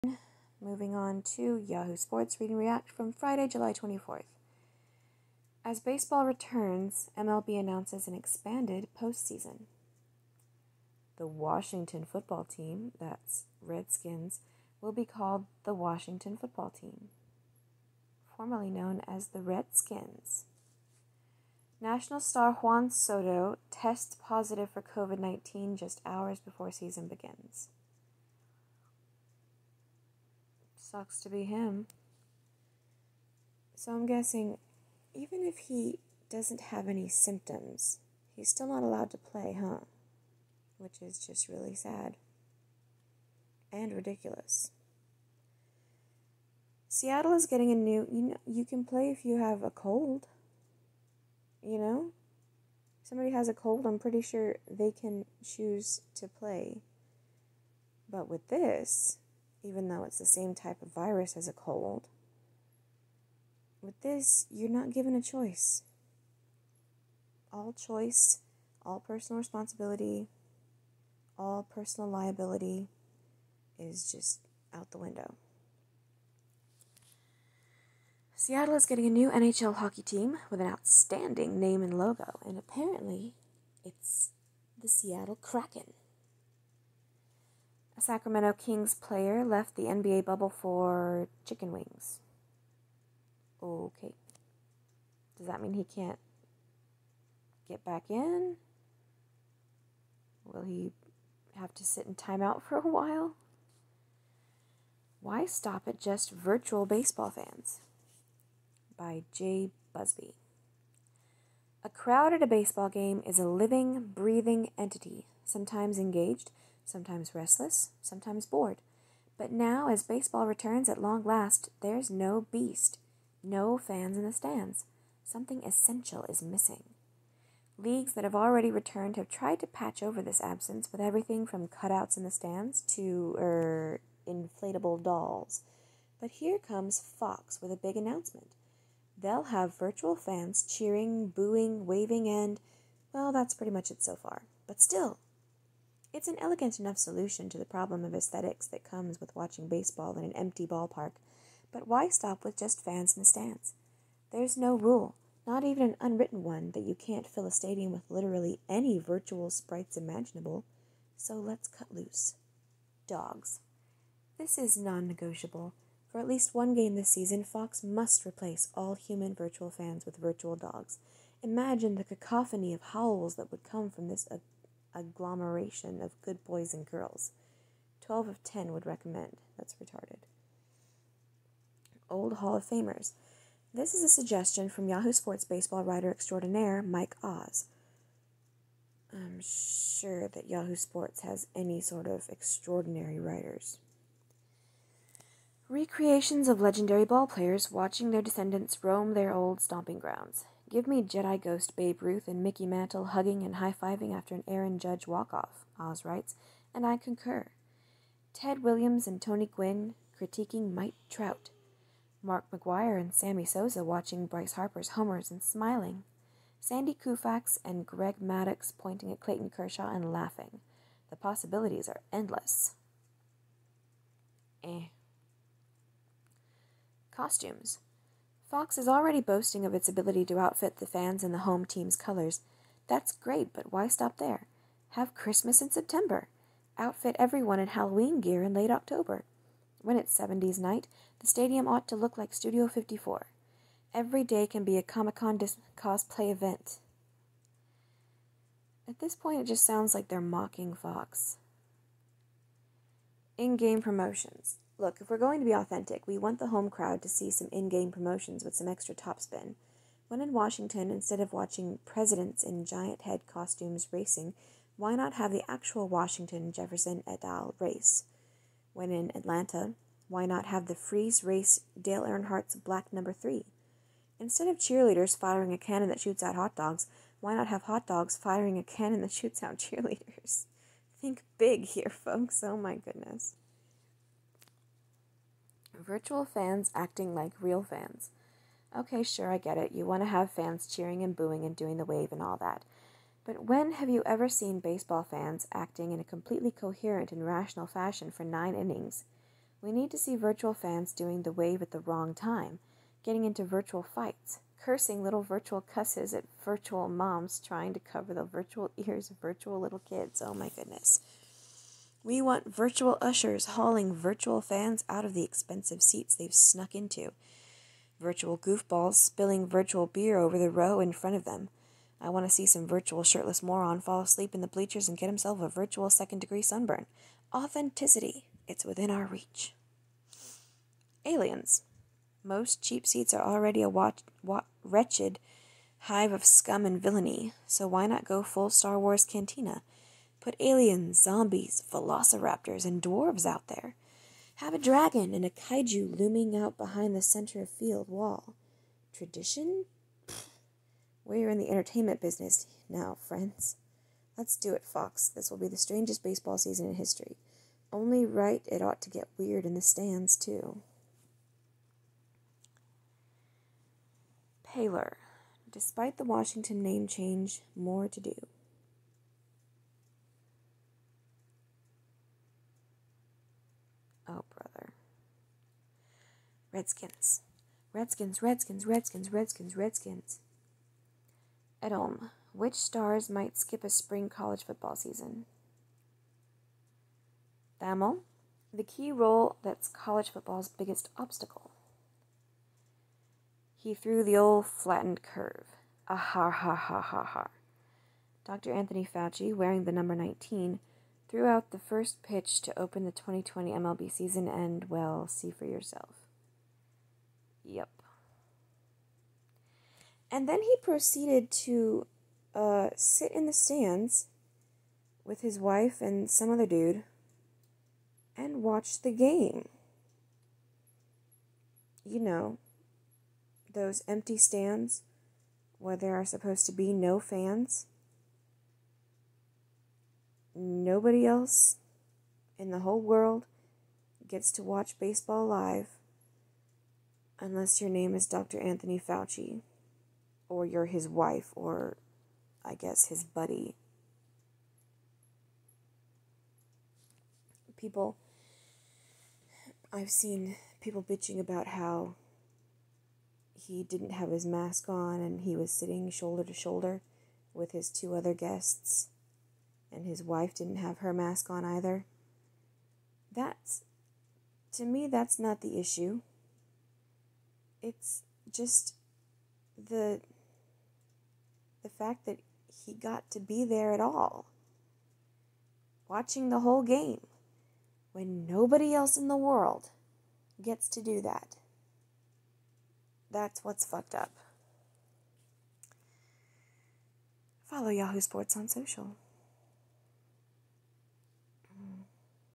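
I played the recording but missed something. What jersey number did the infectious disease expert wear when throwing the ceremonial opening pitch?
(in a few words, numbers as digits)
19.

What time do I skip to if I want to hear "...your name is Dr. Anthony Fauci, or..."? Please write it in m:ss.
7:17.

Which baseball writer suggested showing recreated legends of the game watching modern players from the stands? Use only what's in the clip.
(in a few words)
Mike Oz.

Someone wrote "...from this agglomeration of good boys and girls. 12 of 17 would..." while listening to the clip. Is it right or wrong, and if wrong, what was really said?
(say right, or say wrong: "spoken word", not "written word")
wrong: "10", not "17".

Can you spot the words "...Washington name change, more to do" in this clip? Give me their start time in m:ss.
6:06.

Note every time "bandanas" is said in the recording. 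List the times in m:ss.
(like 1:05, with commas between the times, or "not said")
not said.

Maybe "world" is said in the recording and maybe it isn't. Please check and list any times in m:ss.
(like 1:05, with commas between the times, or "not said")
7:12, 7:59.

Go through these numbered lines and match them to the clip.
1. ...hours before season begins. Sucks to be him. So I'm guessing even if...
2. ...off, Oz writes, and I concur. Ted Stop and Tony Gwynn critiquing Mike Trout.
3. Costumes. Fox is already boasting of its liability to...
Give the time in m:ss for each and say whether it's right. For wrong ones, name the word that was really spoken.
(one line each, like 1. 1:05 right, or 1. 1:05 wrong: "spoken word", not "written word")
1. 0:26 right
2. 3:25 wrong: "Williams", not "Stop"
3. 3:47 wrong: "ability", not "liability".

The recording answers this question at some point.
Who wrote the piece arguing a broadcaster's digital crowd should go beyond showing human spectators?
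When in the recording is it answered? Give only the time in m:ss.
1:49.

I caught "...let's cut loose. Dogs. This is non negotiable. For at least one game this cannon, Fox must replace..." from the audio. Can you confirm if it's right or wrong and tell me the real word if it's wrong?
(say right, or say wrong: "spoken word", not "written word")
wrong: "season", not "cannon".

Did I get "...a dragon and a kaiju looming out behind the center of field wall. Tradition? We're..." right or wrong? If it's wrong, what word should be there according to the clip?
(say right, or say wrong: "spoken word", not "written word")
right.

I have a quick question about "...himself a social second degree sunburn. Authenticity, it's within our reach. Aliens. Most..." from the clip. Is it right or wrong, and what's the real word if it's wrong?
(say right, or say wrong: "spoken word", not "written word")
wrong: "virtual", not "social".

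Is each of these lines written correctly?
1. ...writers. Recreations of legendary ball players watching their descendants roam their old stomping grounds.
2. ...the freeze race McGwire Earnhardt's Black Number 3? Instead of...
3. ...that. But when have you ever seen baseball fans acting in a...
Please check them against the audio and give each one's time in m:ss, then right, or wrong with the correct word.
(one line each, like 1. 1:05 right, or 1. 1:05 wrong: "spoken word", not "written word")
1. 3:13 right
2. 4:30 wrong: "Dale", not "McGwire"
3. 4:52 right.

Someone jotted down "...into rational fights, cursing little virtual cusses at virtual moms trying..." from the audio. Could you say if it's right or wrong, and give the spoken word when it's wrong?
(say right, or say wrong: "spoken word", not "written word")
wrong: "virtual", not "rational".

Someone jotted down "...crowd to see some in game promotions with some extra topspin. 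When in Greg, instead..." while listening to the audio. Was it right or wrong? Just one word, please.
wrong.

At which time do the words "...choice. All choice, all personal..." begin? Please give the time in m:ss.
1:05.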